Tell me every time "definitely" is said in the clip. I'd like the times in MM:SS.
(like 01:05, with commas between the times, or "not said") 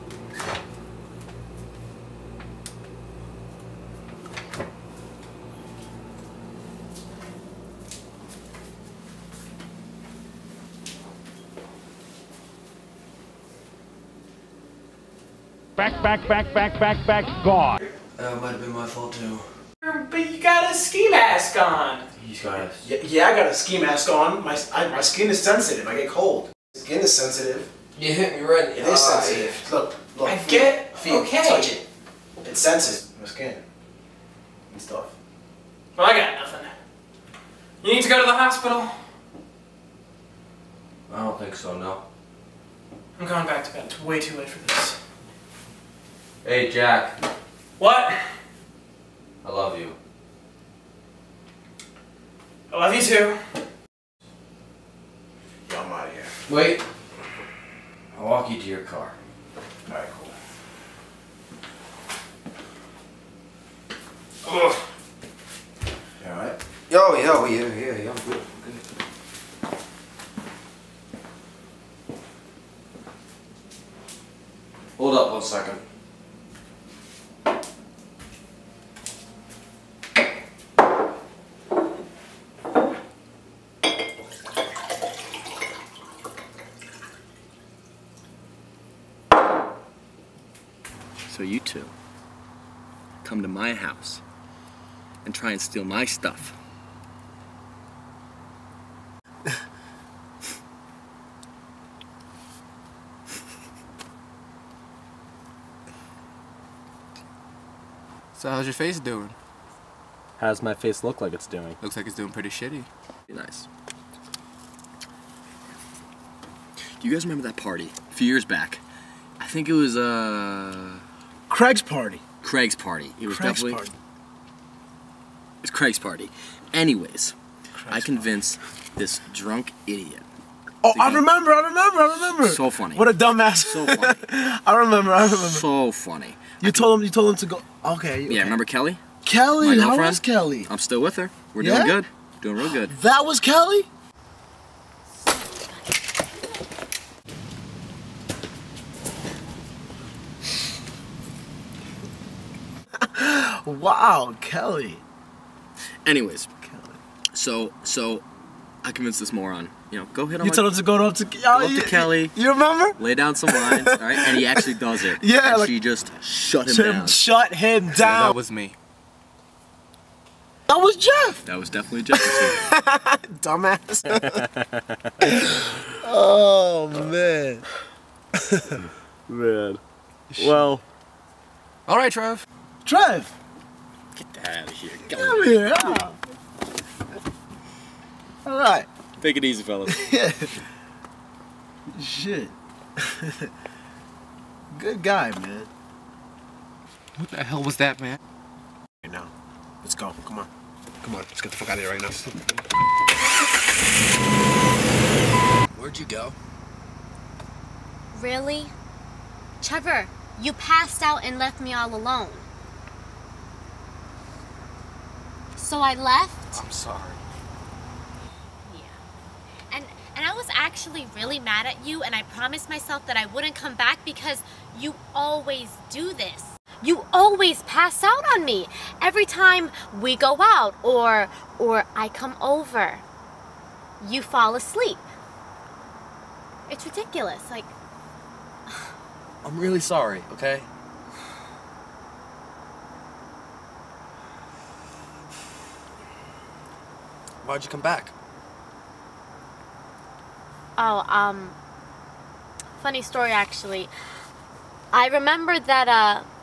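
02:03, 02:51.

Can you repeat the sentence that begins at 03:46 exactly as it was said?
You always pass out on me every time we go out or or I come over.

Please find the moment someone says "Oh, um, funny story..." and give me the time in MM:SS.
04:10.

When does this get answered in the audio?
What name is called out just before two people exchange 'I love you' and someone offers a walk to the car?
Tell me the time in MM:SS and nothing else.
00:46.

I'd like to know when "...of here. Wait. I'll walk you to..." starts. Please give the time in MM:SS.
00:56.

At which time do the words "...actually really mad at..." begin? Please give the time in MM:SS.
03:40.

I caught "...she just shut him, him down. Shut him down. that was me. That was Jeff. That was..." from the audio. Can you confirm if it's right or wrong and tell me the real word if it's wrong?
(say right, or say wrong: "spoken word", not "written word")
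right.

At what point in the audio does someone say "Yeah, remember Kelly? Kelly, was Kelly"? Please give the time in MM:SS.
02:18.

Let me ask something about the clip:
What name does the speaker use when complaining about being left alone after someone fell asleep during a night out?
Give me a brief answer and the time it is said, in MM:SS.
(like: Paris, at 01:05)
Trevor, at 03:29.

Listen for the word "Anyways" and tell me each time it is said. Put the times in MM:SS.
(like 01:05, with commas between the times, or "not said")
02:06, 02:36.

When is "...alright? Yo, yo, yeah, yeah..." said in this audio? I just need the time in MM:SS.
01:06.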